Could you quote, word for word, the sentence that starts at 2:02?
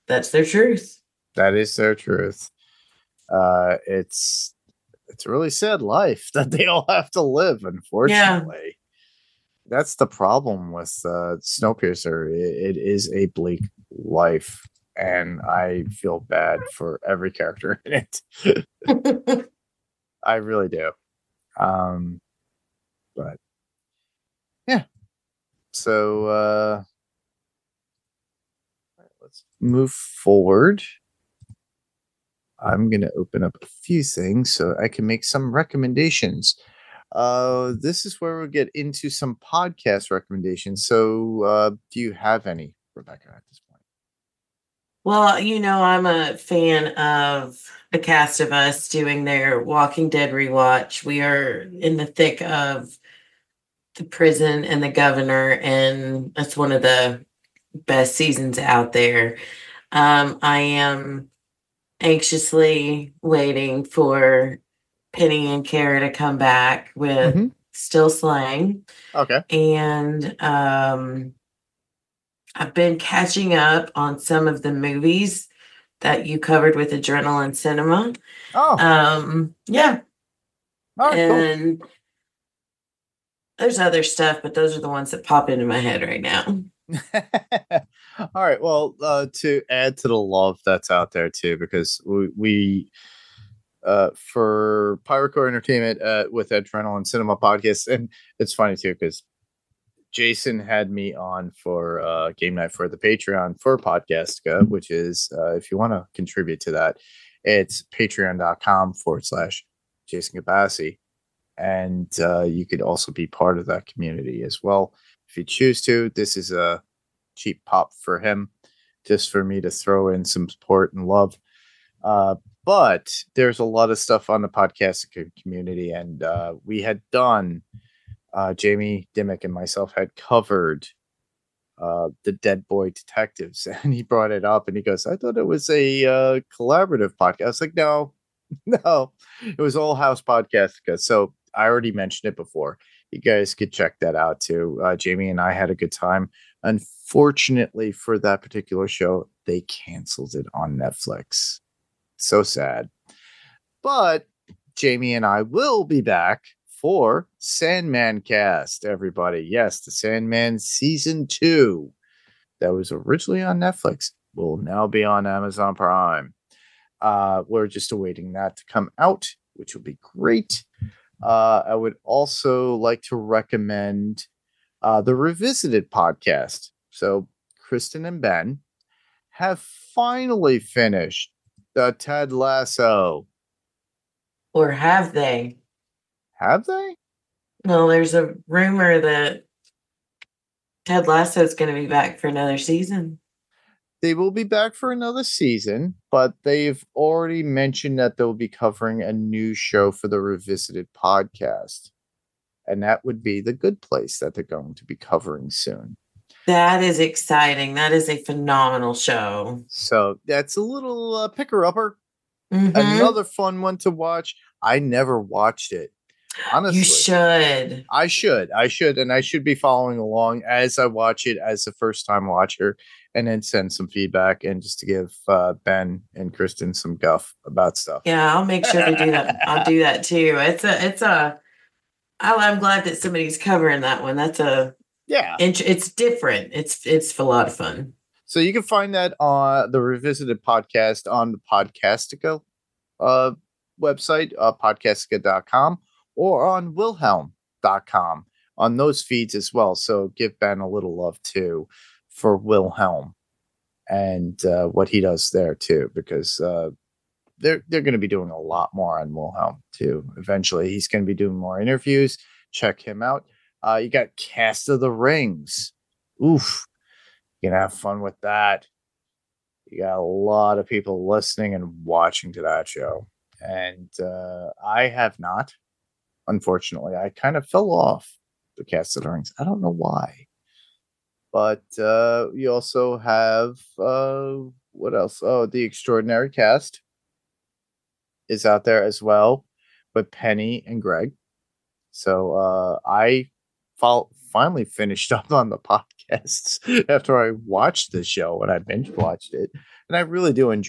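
Uh, but there's a lot of stuff on the podcast community, and uh, we had done.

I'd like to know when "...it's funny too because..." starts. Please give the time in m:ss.
1:38.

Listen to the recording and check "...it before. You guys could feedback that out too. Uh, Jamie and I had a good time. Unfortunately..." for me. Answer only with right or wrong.
wrong.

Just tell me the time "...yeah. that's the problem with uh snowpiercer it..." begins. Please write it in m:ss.
0:08.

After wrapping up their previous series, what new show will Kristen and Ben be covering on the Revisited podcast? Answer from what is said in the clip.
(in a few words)
The Good Place.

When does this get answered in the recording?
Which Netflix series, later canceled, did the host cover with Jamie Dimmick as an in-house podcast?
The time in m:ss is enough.
2:12.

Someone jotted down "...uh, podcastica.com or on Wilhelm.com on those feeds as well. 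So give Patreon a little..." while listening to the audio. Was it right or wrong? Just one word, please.
wrong.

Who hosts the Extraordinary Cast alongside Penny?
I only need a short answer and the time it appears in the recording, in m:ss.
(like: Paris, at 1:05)
Greg, at 4:50.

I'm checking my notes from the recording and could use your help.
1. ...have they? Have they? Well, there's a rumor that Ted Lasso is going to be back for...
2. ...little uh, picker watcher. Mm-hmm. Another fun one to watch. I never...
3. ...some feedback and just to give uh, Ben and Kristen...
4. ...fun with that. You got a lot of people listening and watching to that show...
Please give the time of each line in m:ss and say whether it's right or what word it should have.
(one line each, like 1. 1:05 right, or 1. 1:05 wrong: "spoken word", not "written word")
1. 3:04 right
2. 3:30 wrong: "upper", not "watcher"
3. 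3:43 right
4. 4:27 right.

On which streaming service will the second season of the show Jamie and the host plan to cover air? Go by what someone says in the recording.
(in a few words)
Amazon Prime.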